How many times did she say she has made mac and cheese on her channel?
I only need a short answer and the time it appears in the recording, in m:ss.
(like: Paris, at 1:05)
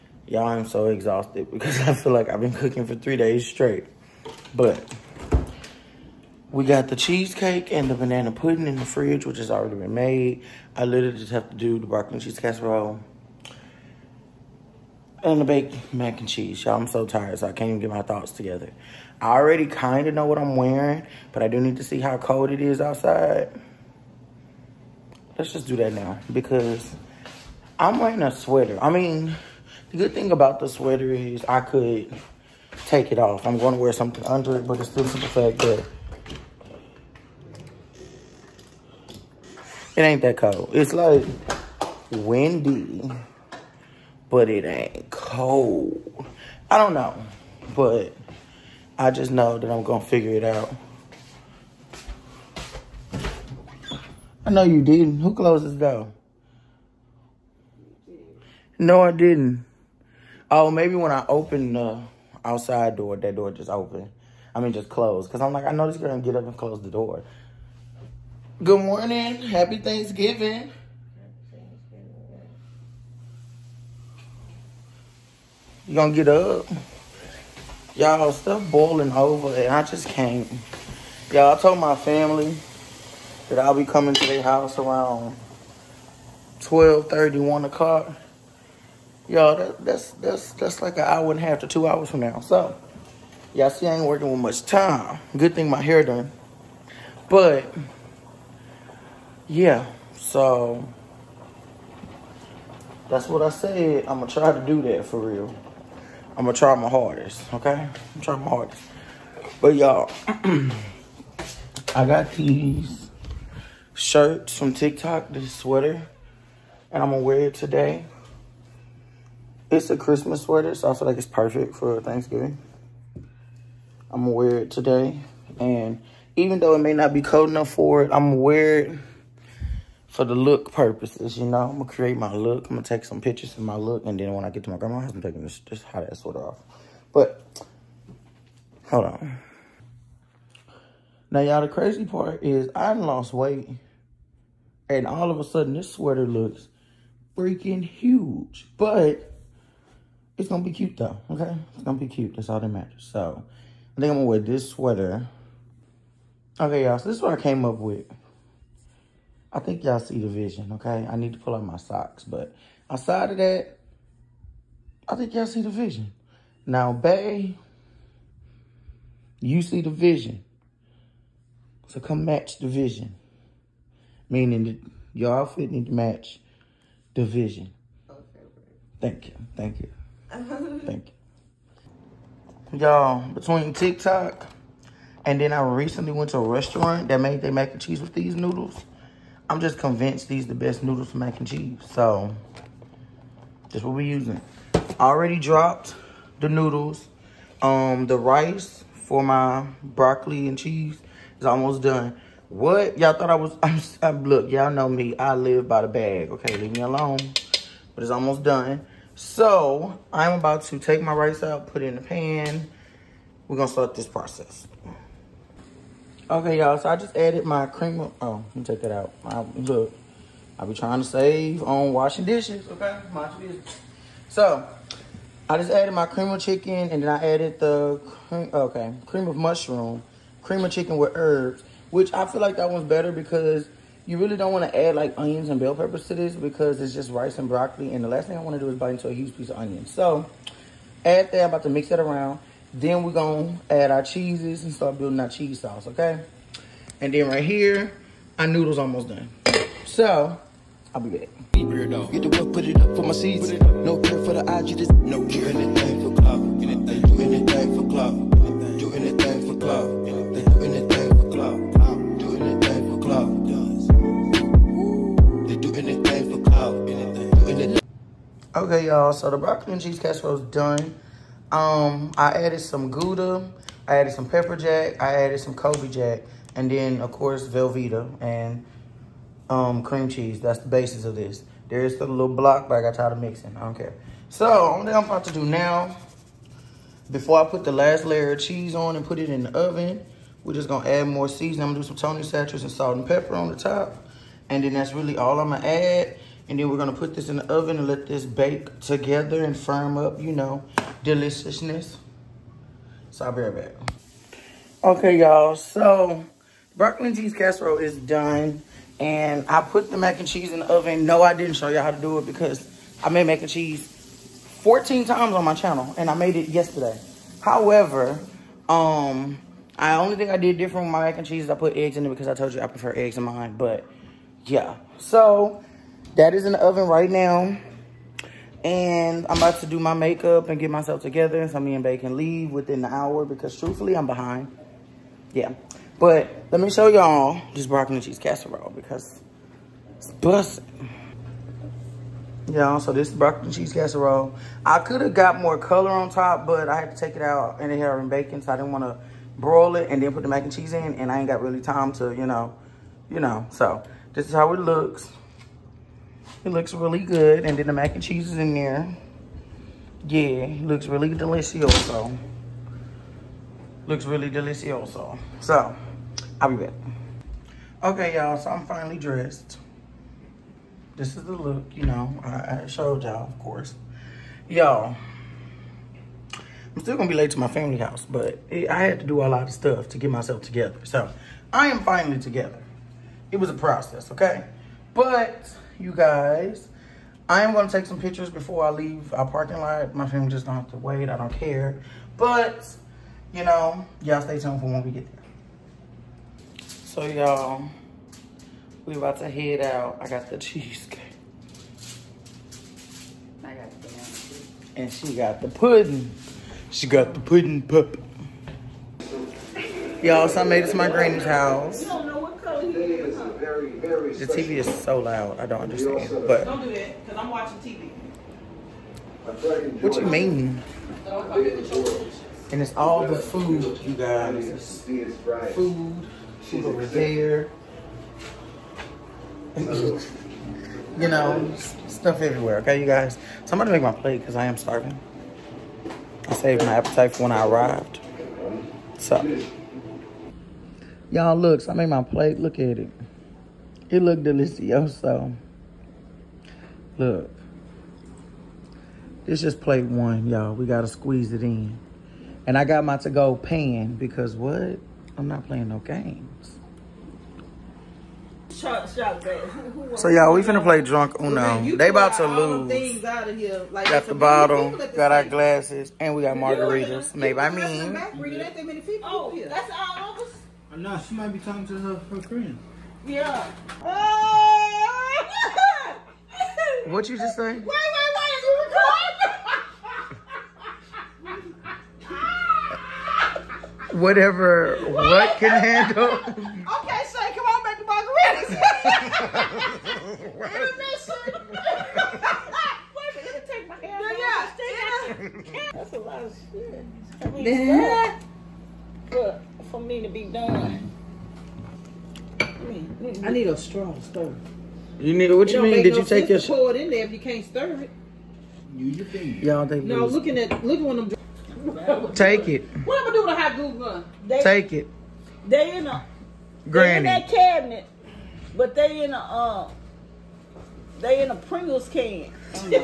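14, at 5:14.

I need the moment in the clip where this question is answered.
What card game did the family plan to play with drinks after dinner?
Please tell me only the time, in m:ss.
7:40.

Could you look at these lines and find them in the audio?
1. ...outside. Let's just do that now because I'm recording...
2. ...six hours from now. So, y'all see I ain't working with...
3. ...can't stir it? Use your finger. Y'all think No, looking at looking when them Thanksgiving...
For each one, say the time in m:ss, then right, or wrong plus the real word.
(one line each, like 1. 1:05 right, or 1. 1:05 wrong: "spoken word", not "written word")
1. 0:22 wrong: "wearing", not "recording"
2. 1:31 wrong: "two", not "six"
3. 8:27 wrong: "Take", not "Thanksgiving".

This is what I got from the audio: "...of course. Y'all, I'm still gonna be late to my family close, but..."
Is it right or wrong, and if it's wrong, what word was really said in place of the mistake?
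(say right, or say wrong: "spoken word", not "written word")
wrong: "house", not "close".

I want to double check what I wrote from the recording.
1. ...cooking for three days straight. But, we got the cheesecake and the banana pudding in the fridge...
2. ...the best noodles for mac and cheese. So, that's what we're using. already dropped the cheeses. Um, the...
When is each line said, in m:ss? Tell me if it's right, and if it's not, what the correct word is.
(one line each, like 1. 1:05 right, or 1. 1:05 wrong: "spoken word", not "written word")
1. 0:02 right
2. 3:10 wrong: "noodles", not "cheeses".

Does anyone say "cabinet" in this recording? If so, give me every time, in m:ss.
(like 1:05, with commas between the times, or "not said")
8:37.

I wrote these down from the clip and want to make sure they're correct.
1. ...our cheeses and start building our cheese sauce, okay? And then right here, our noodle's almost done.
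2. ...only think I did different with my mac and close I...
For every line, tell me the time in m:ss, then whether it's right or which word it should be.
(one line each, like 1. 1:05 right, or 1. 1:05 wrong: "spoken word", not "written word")
1. 4:03 right
2. 5:19 wrong: "cheese", not "close".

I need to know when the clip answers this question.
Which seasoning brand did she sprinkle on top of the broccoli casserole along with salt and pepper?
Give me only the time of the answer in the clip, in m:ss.
4:51.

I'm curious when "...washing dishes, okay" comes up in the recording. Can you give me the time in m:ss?
3:41.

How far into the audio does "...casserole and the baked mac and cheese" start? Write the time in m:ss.
0:12.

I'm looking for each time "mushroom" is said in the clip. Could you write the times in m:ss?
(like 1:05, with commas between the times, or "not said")
3:49.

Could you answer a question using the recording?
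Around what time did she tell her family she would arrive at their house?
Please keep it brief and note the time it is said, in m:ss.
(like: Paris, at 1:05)
12:30, at 1:26.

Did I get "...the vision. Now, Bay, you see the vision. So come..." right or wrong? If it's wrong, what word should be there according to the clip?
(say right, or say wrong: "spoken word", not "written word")
right.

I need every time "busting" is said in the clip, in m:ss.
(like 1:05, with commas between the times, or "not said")
5:40.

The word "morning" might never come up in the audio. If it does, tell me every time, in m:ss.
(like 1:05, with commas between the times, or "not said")
1:08.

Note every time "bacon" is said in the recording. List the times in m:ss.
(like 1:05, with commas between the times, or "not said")
5:48.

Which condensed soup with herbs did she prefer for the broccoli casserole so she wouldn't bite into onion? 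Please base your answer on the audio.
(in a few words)
cream of chicken with herbs.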